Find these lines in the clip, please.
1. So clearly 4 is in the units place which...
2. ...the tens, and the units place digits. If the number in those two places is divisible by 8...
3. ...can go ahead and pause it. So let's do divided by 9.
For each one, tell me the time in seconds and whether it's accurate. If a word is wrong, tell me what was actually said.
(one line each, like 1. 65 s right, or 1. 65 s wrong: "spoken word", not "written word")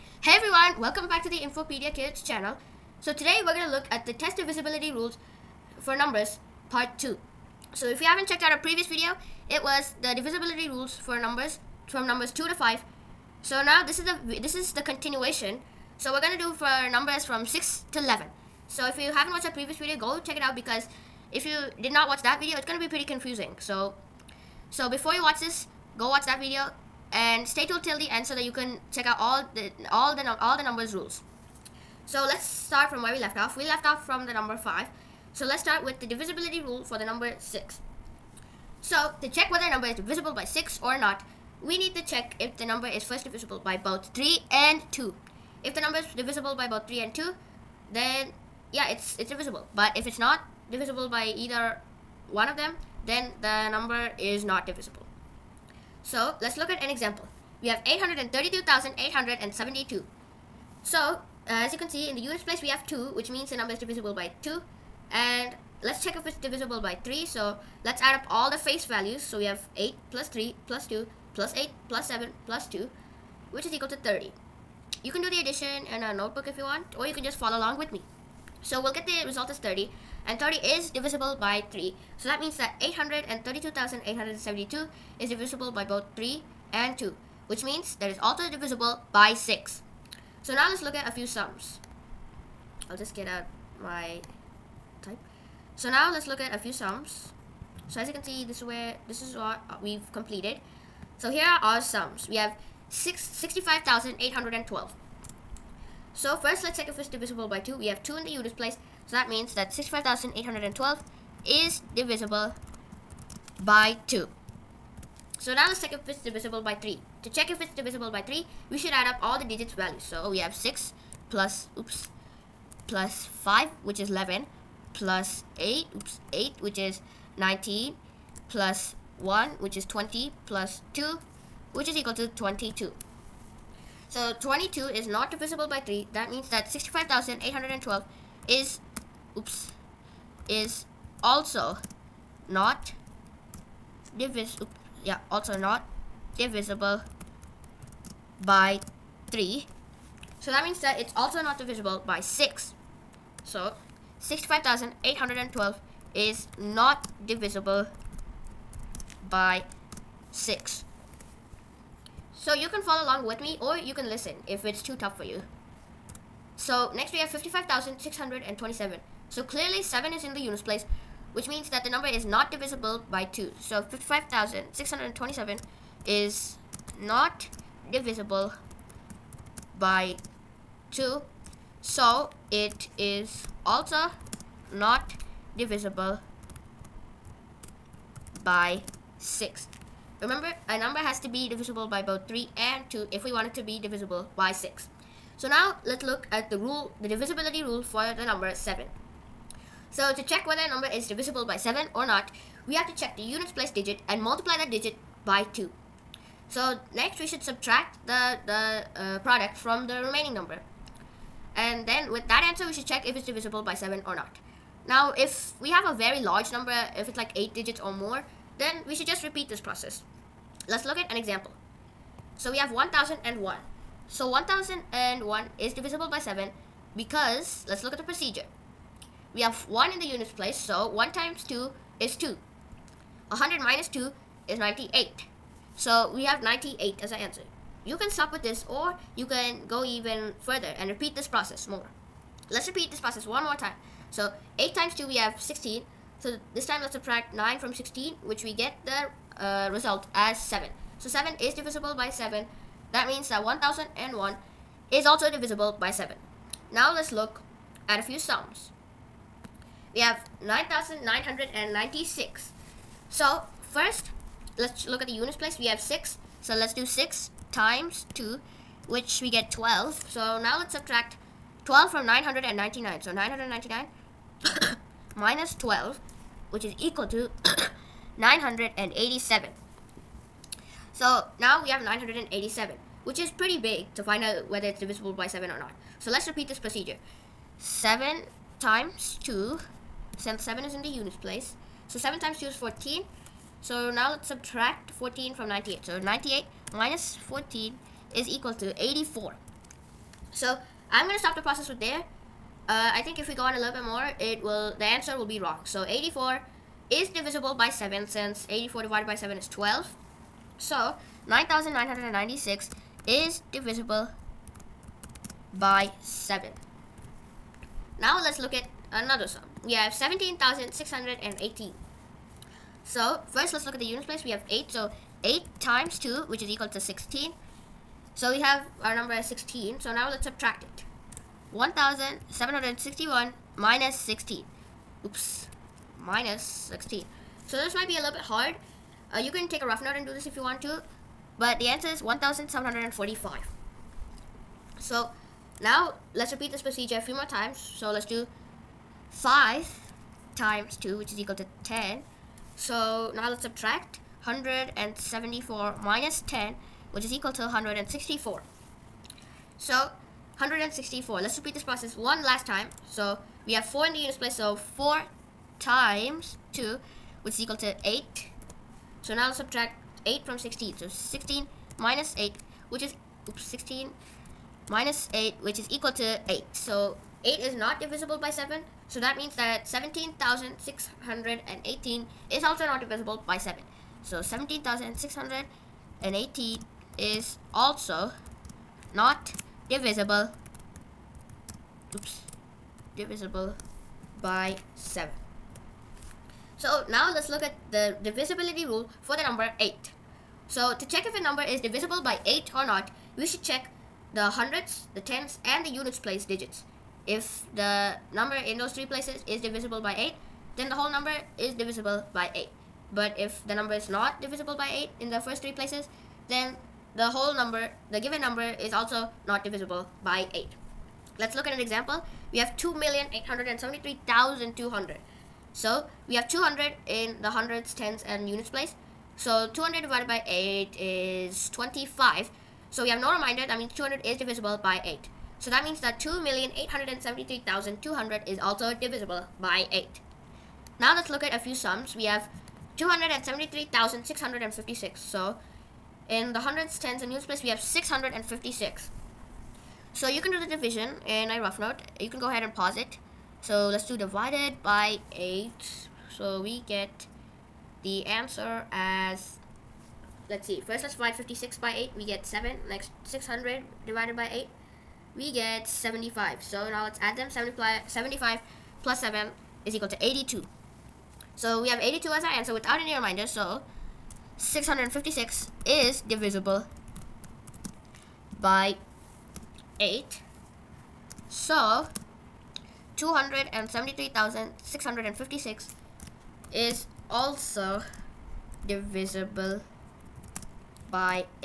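1. 169 s wrong: "7", not "4"
2. 404 s wrong: "three", not "two"
3. 452 s wrong: "8", not "9".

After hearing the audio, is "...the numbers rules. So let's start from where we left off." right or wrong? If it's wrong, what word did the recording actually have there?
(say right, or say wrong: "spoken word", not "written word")
right.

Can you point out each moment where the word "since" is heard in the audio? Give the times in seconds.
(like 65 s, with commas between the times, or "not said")
290 s, 308 s.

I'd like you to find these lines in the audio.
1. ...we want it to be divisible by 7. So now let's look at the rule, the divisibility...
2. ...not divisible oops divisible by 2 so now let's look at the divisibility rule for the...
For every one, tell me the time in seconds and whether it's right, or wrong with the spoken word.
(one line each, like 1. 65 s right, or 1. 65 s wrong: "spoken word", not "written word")
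1. 193 s wrong: "6", not "7"
2. 388 s wrong: "7", not "2".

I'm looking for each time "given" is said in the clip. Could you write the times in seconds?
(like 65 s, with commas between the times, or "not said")
417 s.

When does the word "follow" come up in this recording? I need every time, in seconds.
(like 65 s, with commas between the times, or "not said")
77 s, 162 s.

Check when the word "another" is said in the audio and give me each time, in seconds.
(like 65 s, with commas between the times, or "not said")
318 s.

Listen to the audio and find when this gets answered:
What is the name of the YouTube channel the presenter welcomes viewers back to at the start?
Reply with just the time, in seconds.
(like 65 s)
1 s.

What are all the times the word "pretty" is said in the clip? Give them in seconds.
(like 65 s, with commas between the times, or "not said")
22 s, 283 s.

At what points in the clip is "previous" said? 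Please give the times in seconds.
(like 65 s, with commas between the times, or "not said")
8 s, 19 s.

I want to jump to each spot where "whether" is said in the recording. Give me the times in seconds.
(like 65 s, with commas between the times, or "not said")
39 s, 200 s, 284 s.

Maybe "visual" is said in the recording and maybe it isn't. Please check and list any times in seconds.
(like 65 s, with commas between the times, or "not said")
not said.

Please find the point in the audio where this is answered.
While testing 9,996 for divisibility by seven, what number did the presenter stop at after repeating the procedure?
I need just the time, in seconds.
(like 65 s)
298 s.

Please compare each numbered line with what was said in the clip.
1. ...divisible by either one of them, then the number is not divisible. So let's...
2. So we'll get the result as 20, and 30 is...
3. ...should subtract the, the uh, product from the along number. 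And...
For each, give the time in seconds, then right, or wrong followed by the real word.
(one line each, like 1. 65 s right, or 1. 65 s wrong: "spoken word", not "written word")
1. 50 s right
2. 78 s wrong: "30", not "20"
3. 207 s wrong: "remaining", not "along".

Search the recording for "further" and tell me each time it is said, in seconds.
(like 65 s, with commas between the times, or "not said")
240 s.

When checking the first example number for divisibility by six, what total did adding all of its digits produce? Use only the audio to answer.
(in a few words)
30.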